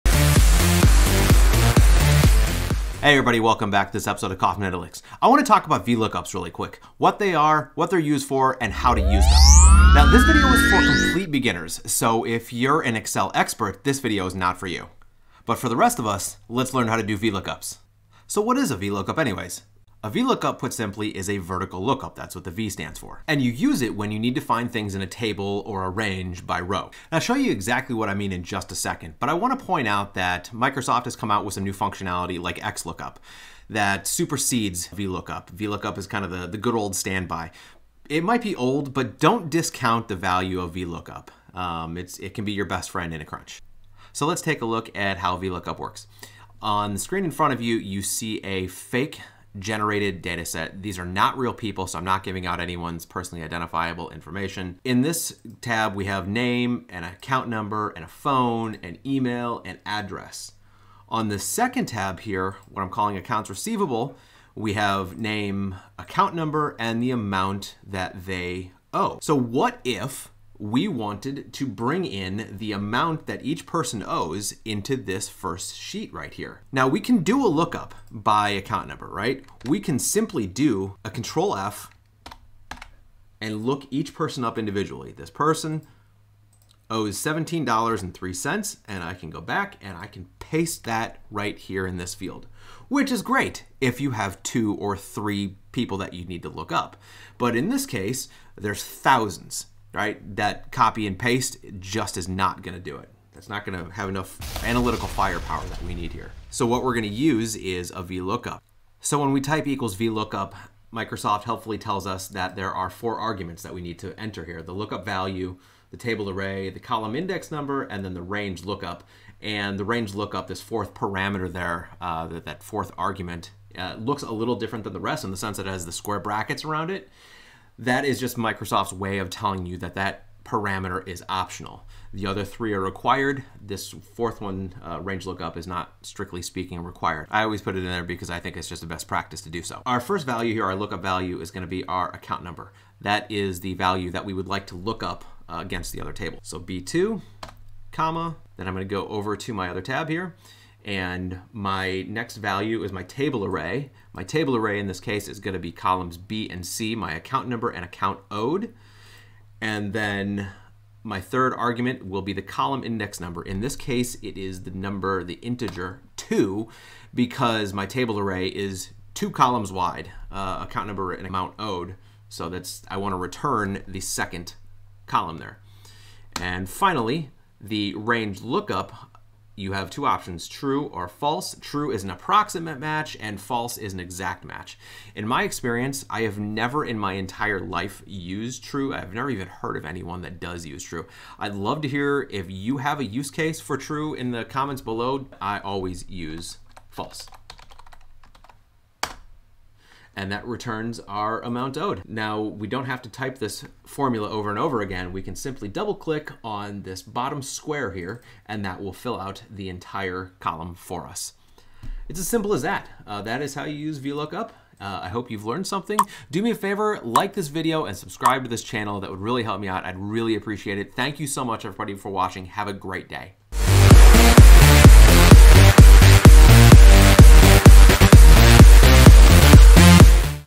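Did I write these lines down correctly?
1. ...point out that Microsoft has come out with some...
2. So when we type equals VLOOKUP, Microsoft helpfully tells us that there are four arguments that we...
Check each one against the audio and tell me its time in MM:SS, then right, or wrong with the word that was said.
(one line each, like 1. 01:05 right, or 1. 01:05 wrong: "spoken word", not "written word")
1. 00:29 right
2. 01:48 right.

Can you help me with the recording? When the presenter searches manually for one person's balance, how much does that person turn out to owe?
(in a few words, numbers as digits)
$17.03.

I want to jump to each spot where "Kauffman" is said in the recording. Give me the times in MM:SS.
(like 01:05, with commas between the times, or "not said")
00:04.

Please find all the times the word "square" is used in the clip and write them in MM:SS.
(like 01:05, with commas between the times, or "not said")
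02:05, 03:27.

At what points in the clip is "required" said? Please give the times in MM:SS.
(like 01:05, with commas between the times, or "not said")
02:12, 02:16.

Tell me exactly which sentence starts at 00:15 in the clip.
But for the rest of us, let's learn how to do VLOOKUPs.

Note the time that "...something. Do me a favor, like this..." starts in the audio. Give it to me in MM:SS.
03:35.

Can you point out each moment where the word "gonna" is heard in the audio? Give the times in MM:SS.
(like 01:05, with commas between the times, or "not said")
02:21, 02:28.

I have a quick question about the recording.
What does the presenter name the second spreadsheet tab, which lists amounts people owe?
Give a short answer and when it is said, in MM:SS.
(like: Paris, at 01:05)
accounts receivable, at 01:03.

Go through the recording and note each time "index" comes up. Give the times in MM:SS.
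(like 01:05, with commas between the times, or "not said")
01:57, 02:42.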